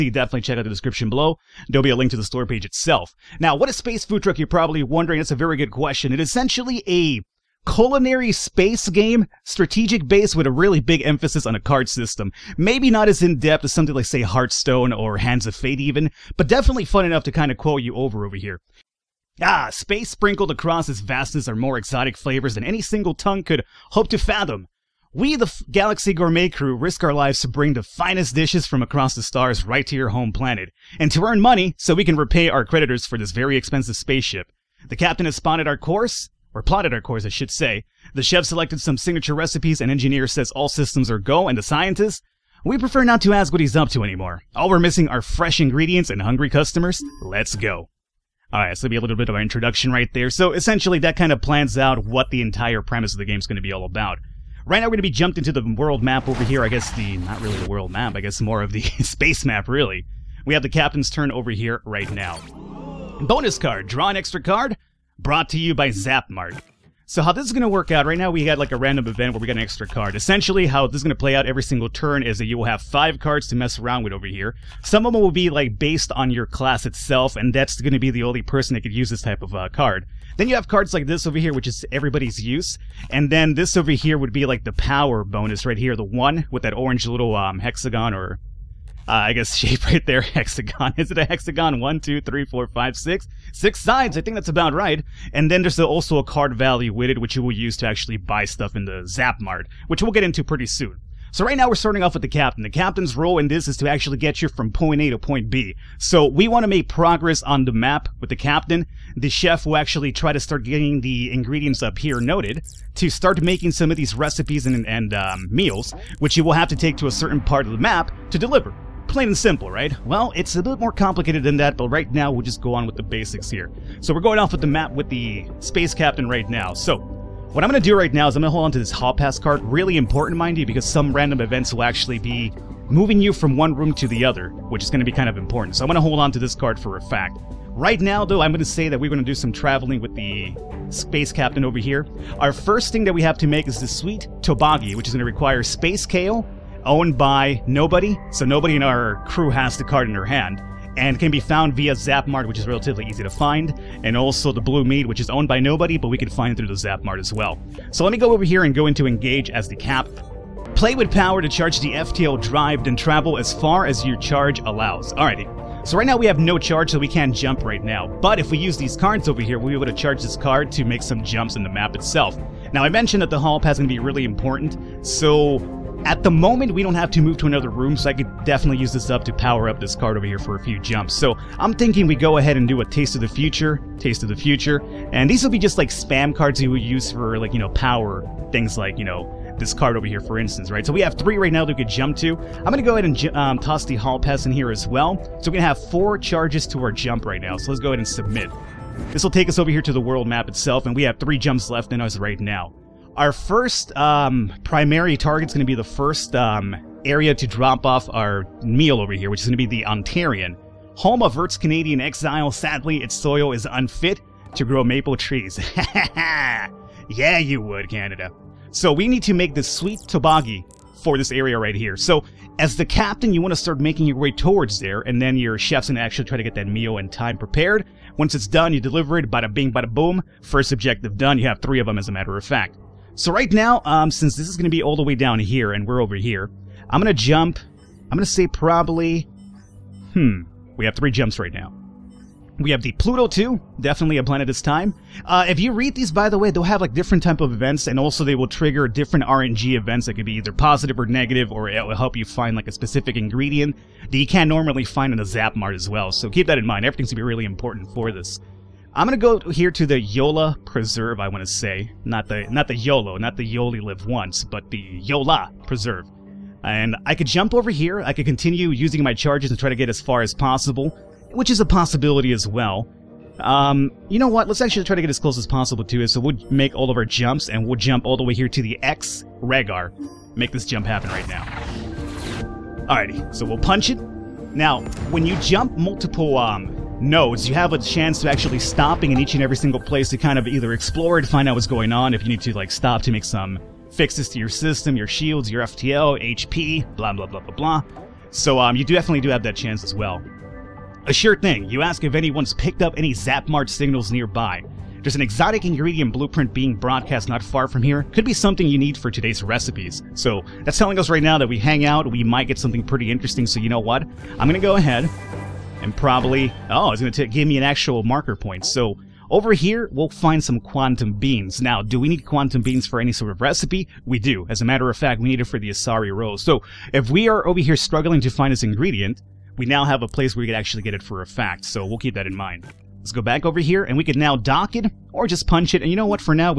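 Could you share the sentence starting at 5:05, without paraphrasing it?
There's an exotic ingredient blueprint being broadcast not far from here.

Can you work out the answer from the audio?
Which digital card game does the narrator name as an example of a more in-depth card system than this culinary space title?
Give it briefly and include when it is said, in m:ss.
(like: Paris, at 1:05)
Hearthstone, at 0:14.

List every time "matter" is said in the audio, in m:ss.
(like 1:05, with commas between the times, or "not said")
3:52, 5:24.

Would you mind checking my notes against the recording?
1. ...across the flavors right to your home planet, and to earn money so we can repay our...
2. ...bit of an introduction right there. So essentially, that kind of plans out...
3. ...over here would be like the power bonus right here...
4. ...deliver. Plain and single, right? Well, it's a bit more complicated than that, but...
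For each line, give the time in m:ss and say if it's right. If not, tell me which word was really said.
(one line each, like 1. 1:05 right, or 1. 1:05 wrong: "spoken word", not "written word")
1. 0:28 wrong: "stars", not "flavors"
2. 0:49 right
3. 1:23 right
4. 1:58 wrong: "simple", not "single".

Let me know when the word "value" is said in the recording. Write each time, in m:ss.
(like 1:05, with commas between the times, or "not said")
1:36.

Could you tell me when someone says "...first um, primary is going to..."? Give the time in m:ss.
3:23.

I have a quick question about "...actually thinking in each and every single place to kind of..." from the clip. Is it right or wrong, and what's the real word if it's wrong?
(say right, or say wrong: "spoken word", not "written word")
wrong: "stopping", not "thinking".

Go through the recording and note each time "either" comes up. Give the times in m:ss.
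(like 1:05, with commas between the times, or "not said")
4:10, 4:50.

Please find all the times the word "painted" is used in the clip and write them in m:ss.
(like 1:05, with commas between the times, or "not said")
not said.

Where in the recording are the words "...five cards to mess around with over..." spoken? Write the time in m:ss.
1:12.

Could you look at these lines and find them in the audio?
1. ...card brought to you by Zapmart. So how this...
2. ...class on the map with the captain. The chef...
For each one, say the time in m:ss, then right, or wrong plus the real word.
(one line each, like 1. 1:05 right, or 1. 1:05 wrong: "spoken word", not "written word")
1. 1:04 right
2. 1:46 wrong: "progress", not "class".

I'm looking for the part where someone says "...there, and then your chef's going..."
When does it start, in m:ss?
3:44.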